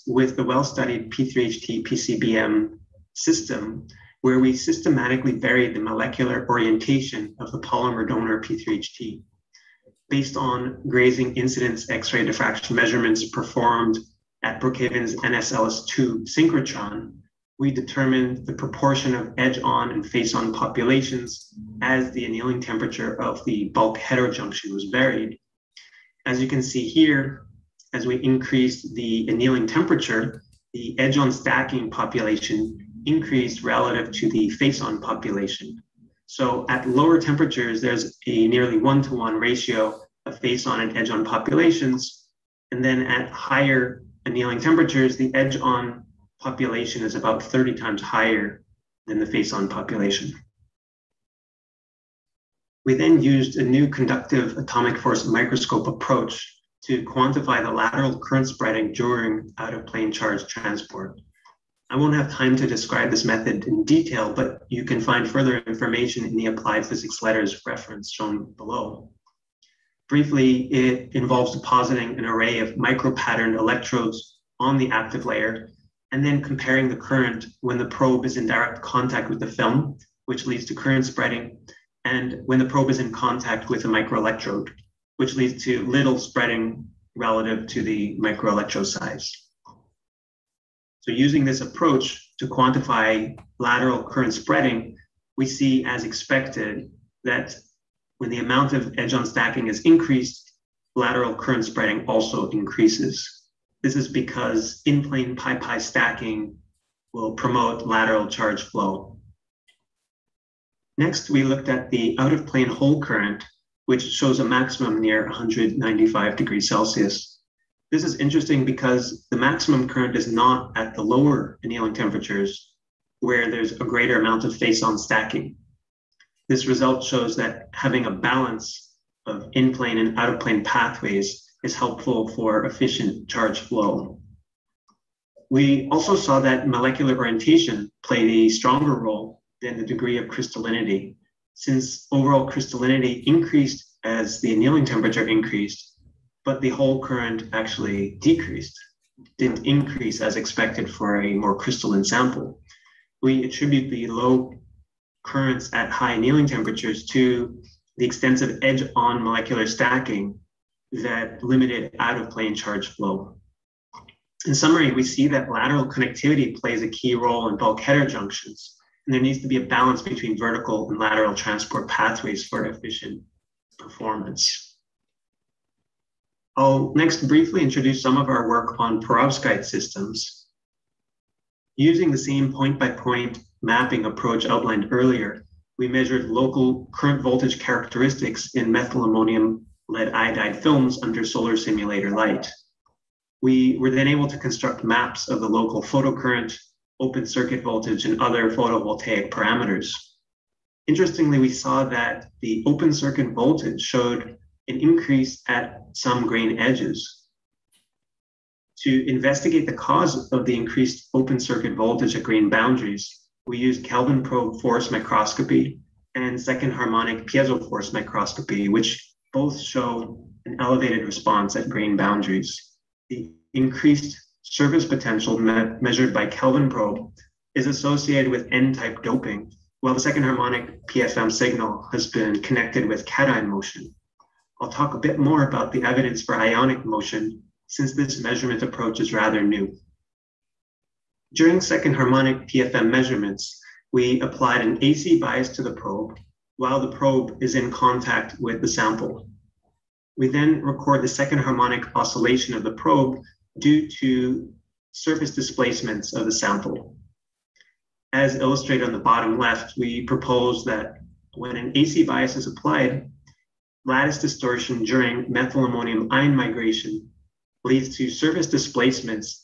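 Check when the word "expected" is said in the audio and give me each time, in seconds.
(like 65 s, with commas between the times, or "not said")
96 s, 150 s.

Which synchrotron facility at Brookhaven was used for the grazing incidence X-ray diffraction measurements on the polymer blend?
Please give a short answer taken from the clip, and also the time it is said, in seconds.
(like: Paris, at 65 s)
NSLS2, at 15 s.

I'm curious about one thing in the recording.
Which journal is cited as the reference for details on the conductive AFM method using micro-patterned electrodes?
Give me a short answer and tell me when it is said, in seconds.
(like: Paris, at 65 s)
Applied Physics Letters, at 66 s.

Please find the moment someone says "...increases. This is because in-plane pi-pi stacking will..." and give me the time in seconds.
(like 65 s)
102 s.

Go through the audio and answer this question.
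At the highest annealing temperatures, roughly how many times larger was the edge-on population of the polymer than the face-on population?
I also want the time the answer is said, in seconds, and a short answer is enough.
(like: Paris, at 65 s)
30, at 47 s.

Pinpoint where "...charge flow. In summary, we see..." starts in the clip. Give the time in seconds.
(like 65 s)
162 s.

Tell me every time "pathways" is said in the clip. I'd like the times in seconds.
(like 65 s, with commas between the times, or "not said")
130 s, 171 s.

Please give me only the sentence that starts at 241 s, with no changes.
During second harmonic PFM measurements, we applied an AC bias to the probe while the probe is in contact with the sample.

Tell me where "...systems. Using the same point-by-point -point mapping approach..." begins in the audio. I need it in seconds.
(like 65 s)
179 s.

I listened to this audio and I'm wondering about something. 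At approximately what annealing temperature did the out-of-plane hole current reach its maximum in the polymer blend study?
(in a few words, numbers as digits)
195 degrees Celsius.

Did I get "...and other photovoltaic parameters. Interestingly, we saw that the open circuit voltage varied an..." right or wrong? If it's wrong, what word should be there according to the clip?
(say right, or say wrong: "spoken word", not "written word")
wrong: "showed", not "varied".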